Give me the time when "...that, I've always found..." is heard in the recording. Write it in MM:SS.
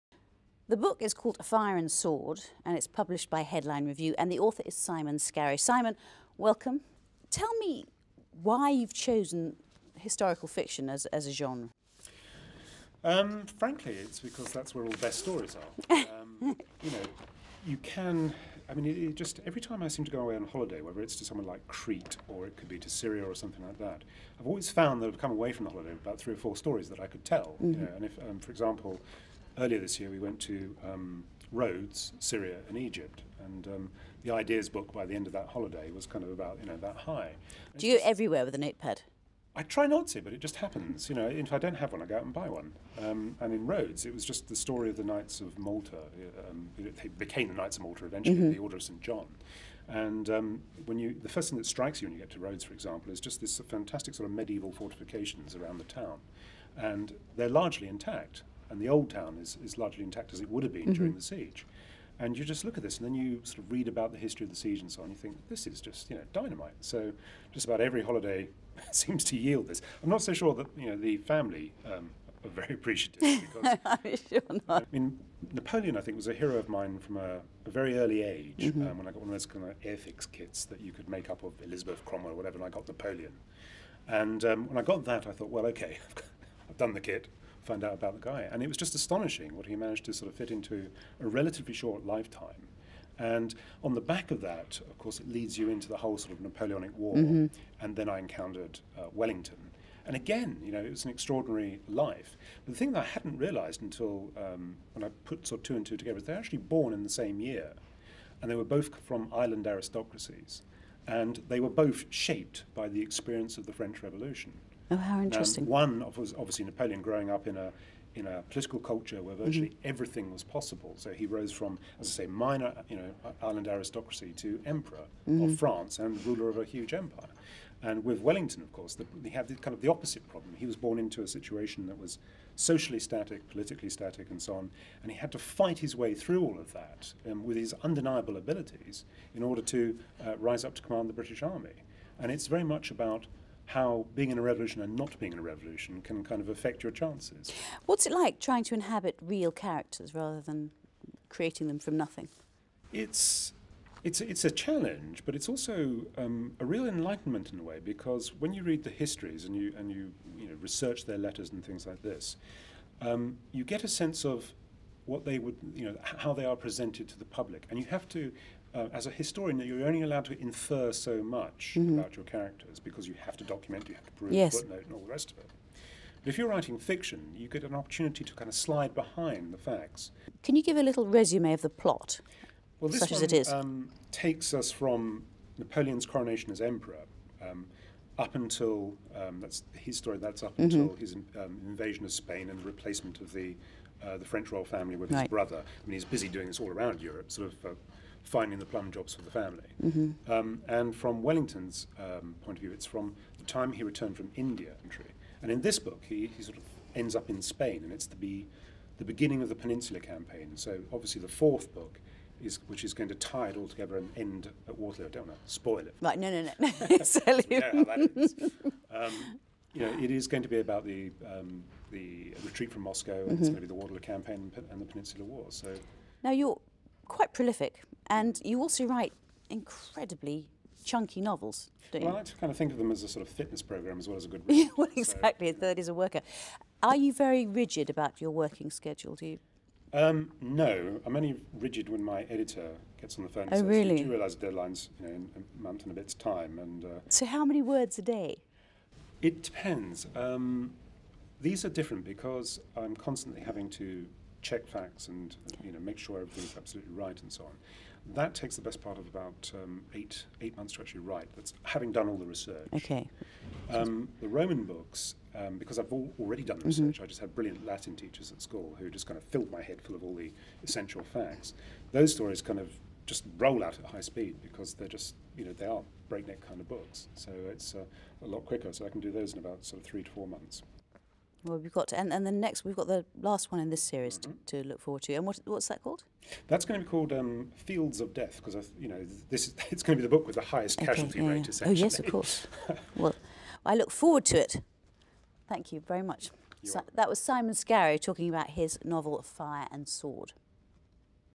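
00:23.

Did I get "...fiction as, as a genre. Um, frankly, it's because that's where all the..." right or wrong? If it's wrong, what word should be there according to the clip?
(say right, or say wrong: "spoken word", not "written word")
right.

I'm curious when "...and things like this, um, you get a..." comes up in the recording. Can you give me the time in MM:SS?
02:41.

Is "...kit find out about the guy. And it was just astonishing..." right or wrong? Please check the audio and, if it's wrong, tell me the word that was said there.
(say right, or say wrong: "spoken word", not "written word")
right.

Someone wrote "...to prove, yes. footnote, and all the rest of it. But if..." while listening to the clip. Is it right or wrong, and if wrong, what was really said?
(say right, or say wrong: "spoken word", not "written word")
right.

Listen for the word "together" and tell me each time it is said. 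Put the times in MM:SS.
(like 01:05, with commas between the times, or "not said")
01:45, 03:33.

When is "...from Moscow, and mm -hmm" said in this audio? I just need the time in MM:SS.
03:42.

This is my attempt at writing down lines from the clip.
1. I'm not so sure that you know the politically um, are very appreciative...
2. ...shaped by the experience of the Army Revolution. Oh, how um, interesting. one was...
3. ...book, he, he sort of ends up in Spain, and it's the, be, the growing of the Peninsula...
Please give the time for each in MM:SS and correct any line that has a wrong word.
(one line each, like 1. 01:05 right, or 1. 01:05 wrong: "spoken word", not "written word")
1. 01:10 wrong: "family", not "politically"
2. 01:52 wrong: "French", not "Army"
3. 03:25 wrong: "beginning", not "growing".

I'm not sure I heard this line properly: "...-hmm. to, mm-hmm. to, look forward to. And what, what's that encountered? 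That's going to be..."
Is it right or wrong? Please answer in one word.
wrong.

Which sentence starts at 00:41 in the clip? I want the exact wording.
You know, if I don't have one, I go out and buy one.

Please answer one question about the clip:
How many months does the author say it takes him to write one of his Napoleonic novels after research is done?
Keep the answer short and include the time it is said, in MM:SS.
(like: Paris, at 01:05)
8, at 04:19.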